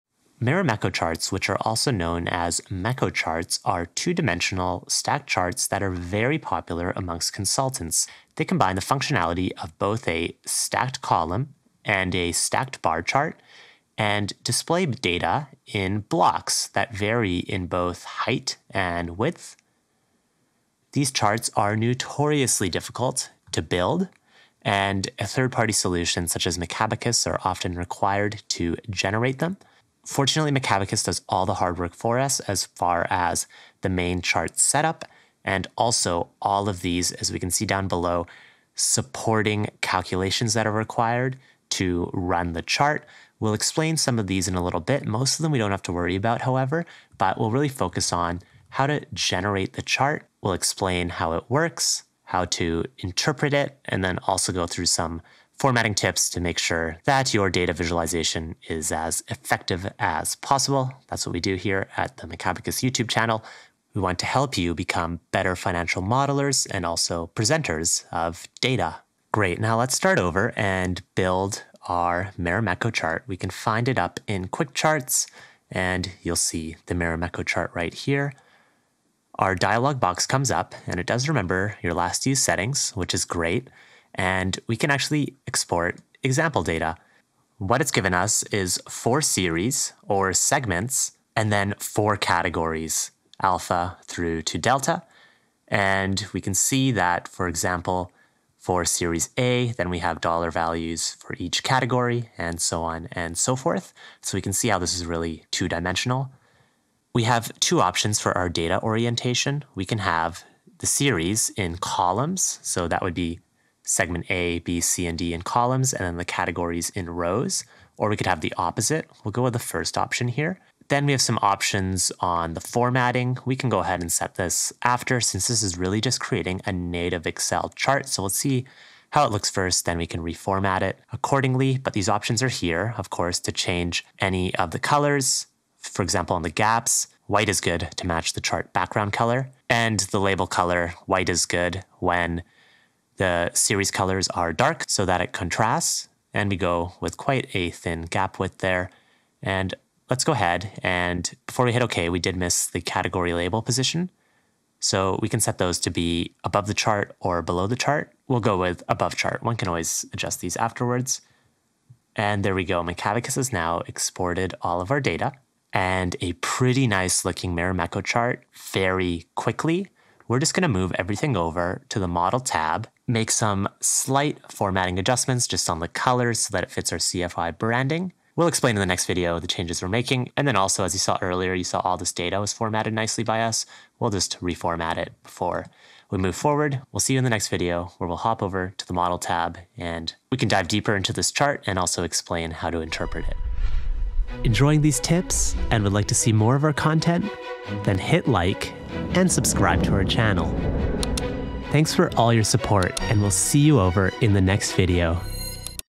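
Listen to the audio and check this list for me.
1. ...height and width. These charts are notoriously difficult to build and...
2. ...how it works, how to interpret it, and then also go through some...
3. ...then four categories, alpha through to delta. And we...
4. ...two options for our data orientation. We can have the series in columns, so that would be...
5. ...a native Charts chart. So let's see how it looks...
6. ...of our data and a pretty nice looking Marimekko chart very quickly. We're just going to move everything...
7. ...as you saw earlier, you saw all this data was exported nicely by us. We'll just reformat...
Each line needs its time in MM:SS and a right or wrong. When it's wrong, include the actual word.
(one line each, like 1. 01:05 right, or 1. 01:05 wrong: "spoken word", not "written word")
1. 00:18 right
2. 00:51 right
3. 01:31 right
4. 01:47 right
5. 02:06 wrong: "Excel", not "Charts"
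6. 02:44 right
7. 03:00 wrong: "formatted", not "exported".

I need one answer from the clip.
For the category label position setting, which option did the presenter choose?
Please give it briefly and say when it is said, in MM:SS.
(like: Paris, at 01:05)
Above chart, at 02:38.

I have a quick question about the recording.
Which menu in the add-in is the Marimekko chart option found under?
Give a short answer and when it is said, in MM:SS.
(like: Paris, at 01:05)
Quick Charts, at 01:14.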